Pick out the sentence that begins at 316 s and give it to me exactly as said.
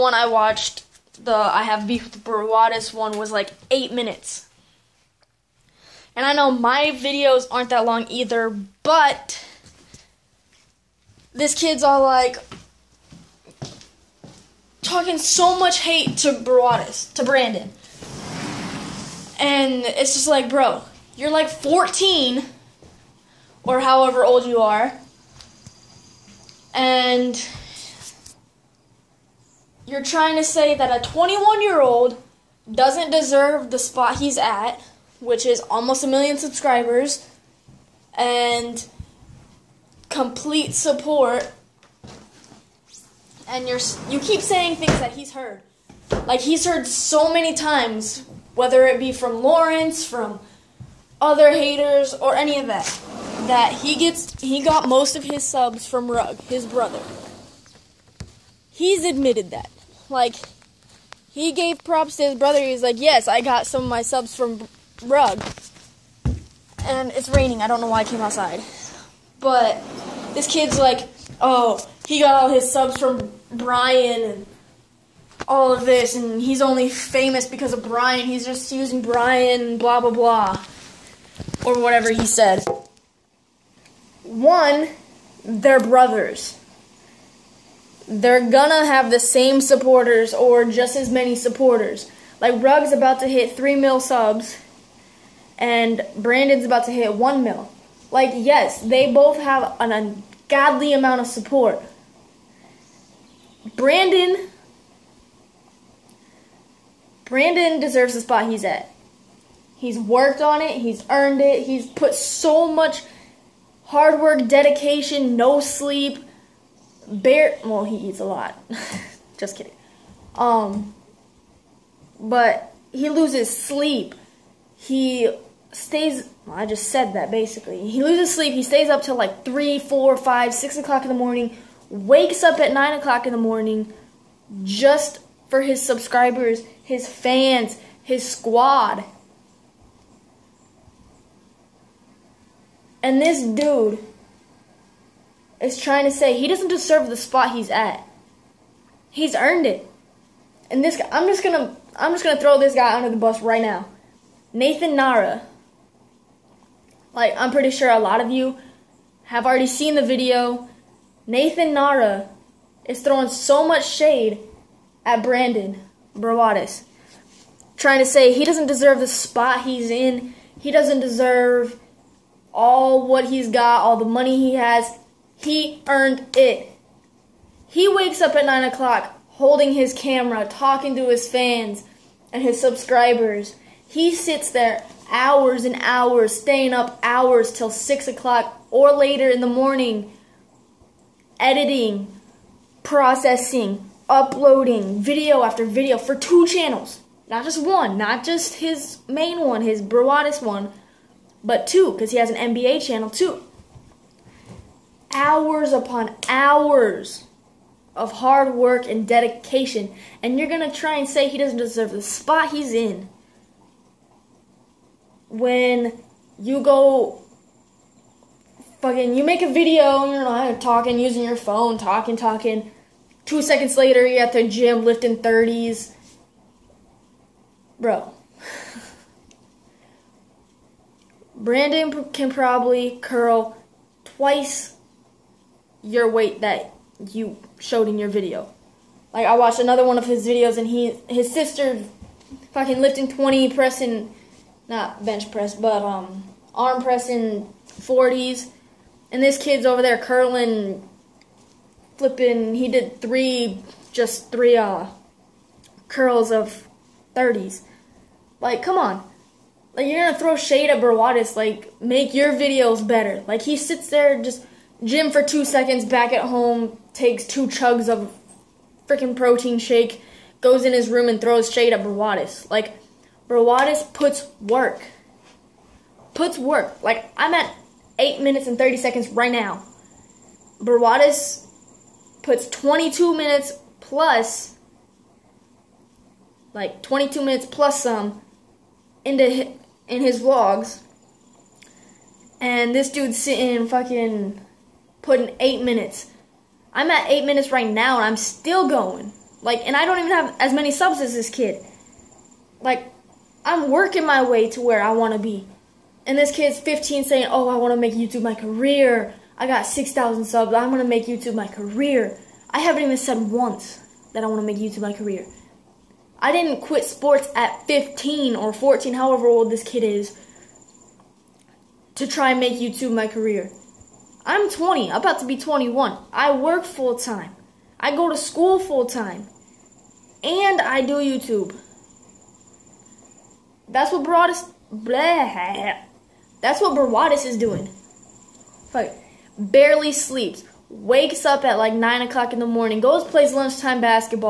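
I didn't quit sports at 15 or 14, however old this kid is, to try and make YouTube my career.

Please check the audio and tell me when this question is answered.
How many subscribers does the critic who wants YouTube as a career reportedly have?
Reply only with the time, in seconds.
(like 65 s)
309 s.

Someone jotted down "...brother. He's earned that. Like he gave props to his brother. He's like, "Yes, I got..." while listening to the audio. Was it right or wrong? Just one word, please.
wrong.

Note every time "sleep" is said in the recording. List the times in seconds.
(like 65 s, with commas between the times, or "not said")
115 s, 123 s, 128 s, 339 s.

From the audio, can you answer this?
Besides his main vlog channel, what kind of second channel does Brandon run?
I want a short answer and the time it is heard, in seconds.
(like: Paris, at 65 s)
NBA channel, at 202 s.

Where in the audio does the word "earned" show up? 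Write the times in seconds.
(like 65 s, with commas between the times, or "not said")
111 s, 149 s, 175 s.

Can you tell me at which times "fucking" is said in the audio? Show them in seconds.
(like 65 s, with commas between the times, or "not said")
218 s, 242 s, 293 s.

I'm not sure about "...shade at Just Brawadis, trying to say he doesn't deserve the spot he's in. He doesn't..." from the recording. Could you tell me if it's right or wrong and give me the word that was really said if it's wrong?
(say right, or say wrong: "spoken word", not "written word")
wrong: "Brandon", not "Just".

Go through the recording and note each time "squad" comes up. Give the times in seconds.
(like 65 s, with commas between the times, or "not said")
138 s.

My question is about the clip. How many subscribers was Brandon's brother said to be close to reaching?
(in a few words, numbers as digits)
3 mil.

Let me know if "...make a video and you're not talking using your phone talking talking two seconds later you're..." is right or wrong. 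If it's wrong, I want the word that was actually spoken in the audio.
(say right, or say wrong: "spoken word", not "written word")
right.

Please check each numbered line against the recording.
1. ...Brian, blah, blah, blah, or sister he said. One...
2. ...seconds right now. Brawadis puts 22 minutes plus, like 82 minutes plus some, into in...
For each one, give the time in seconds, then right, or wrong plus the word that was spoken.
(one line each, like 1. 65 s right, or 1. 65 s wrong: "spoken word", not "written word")
1. 79 s wrong: "whatever", not "sister"
2. 278 s wrong: "22", not "82".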